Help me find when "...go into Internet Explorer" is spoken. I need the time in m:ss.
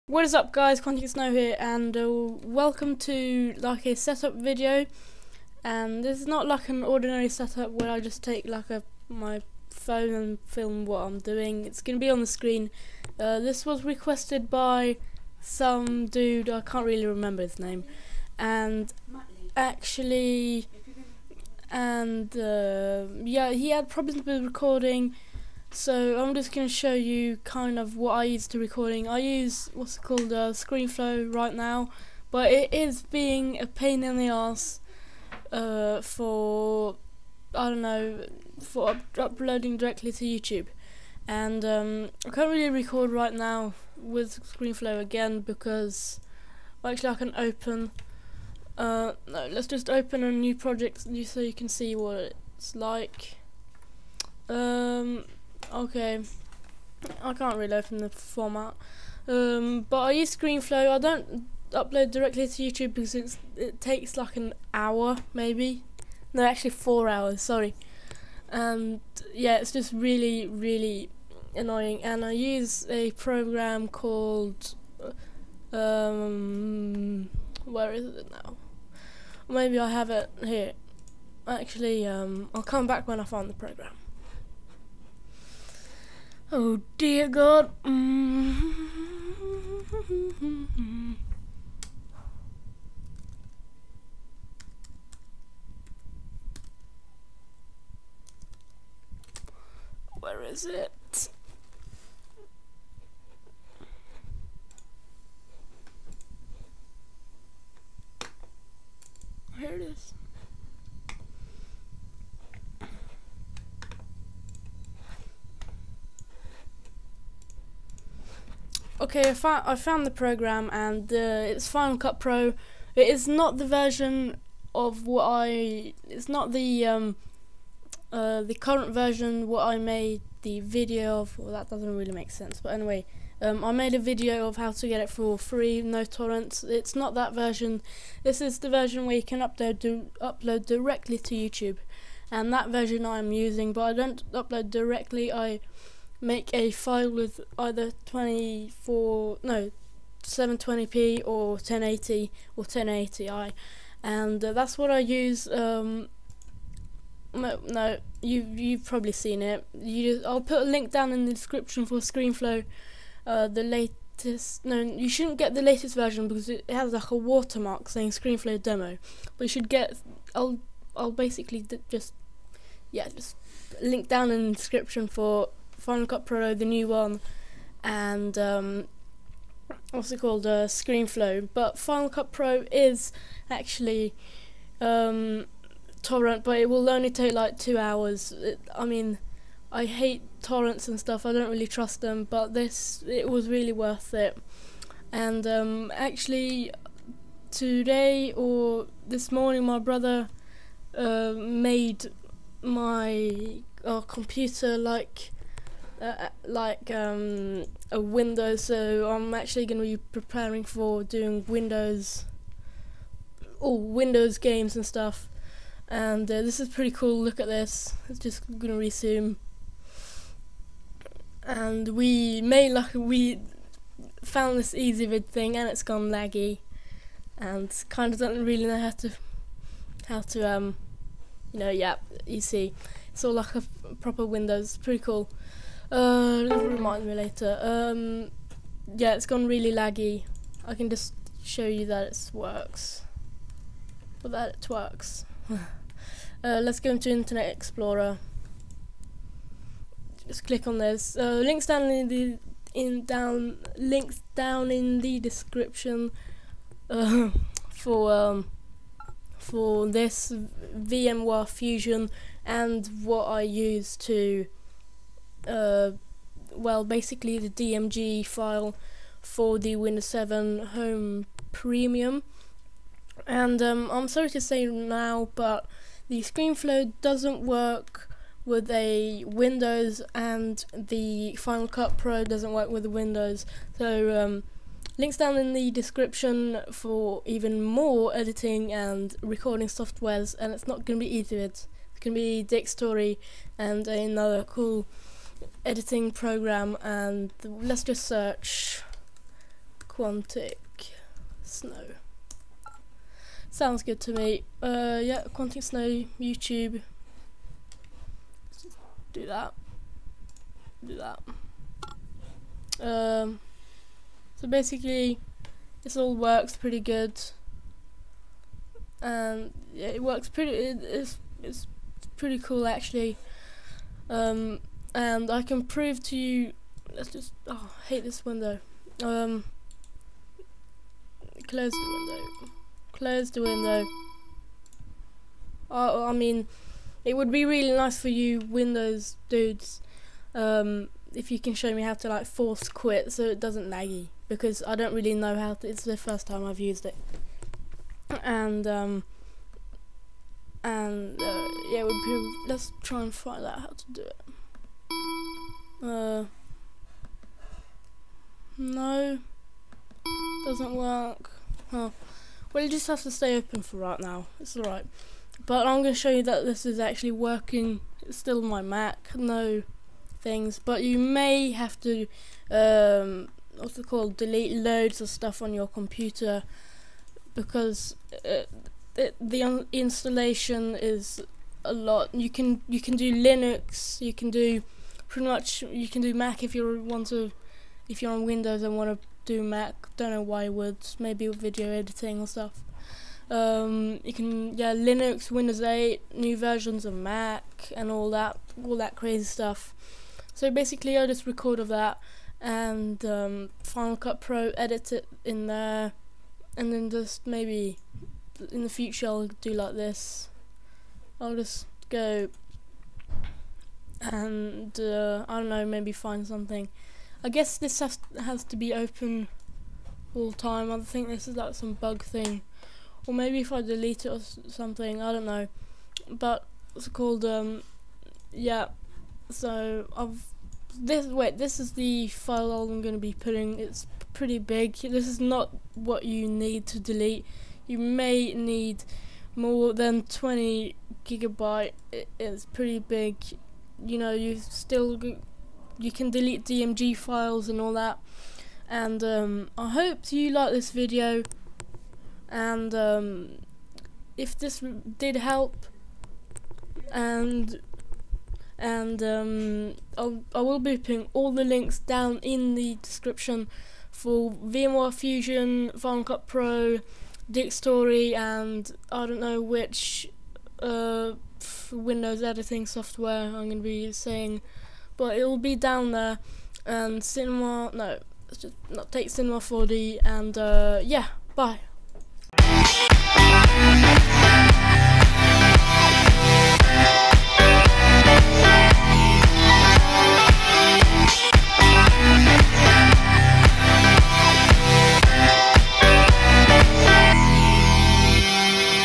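4:06.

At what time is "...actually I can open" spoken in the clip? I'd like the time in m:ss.
0:46.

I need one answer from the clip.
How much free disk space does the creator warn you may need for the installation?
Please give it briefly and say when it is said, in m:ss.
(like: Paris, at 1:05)
More than 20 GB, at 7:19.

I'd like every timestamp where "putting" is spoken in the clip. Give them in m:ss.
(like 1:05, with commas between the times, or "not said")
7:13, 7:40.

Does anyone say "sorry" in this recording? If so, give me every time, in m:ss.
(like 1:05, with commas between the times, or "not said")
1:07, 4:34.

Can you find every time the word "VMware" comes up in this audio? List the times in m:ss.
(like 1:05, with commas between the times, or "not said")
4:20, 7:44.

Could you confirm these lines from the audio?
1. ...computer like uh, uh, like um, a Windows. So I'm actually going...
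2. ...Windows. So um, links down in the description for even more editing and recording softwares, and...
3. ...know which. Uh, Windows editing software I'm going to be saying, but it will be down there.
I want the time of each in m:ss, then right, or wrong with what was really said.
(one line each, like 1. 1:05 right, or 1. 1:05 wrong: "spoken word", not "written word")
1. 3:24 right
2. 4:42 right
3. 7:49 right.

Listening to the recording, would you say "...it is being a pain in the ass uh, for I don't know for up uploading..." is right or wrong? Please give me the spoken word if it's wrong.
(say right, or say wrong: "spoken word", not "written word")
right.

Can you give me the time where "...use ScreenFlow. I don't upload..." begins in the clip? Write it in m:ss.
1:00.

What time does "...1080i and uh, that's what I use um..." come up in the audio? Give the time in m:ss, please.
2:32.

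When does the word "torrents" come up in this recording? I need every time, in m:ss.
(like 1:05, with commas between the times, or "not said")
2:16, 3:06, 3:10.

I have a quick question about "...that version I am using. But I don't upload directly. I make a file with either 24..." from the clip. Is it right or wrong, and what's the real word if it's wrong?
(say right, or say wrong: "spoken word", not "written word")
right.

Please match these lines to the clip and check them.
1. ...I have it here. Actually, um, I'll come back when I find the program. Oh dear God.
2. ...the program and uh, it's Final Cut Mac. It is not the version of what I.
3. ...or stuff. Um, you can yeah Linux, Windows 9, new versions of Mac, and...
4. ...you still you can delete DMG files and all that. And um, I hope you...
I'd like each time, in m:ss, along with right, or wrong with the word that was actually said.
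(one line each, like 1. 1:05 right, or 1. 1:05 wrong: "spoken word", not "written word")
1. 1:19 right
2. 2:00 wrong: "Pro", not "Mac"
3. 6:32 wrong: "8", not "9"
4. 7:24 right.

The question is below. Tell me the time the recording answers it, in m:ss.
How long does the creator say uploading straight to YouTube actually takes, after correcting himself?
1:06.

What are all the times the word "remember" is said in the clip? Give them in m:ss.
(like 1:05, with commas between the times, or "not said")
0:17.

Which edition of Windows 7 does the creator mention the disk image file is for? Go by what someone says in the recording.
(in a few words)
Windows 7 Home Premium.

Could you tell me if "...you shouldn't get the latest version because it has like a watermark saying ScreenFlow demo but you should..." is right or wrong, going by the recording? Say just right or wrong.
right.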